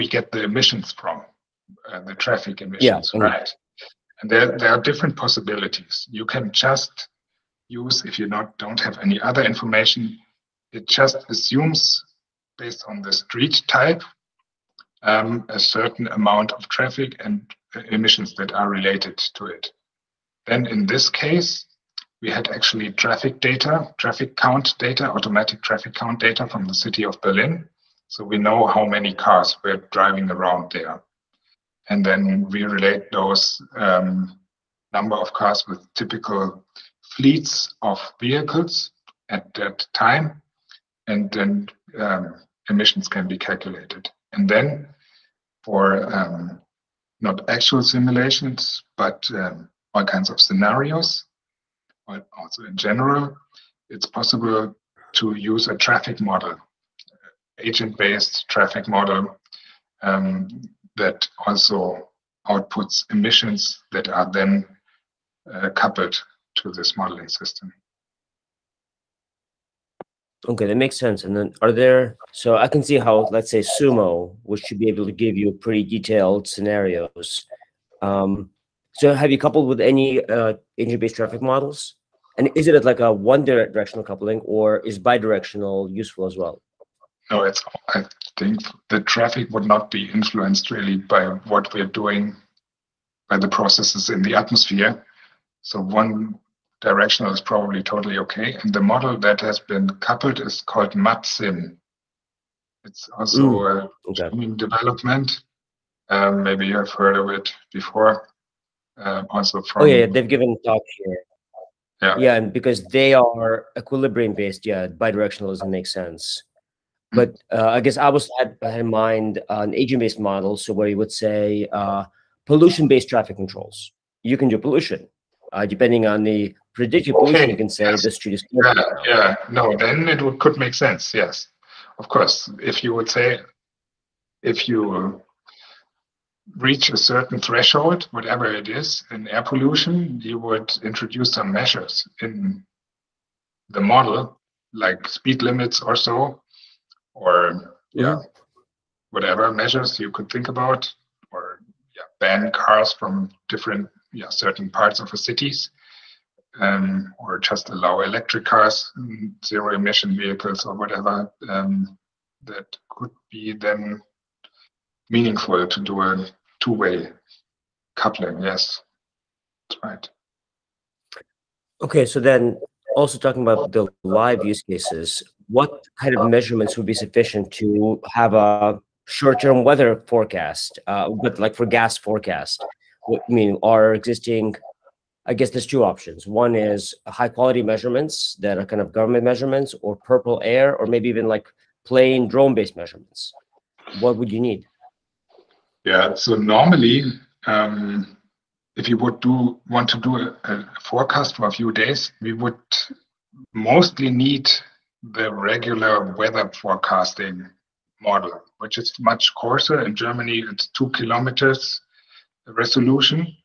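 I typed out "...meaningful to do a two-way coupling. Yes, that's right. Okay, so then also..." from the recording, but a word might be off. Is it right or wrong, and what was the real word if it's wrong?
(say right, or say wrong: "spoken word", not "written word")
right.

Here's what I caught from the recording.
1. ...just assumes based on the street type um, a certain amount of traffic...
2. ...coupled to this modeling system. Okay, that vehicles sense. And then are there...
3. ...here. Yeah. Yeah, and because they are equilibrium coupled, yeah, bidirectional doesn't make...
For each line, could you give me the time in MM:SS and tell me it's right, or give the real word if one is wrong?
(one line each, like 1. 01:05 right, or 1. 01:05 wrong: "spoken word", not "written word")
1. 00:10 right
2. 01:05 wrong: "makes", not "vehicles"
3. 01:51 wrong: "based", not "coupled".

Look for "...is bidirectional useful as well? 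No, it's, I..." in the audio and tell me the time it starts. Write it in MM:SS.
01:24.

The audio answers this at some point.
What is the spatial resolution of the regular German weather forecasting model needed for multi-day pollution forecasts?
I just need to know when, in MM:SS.
03:30.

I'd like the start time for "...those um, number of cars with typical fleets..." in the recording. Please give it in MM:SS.
00:33.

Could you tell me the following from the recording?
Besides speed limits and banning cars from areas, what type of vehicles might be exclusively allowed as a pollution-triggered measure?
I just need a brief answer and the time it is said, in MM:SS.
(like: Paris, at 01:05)
Electric cars, at 02:37.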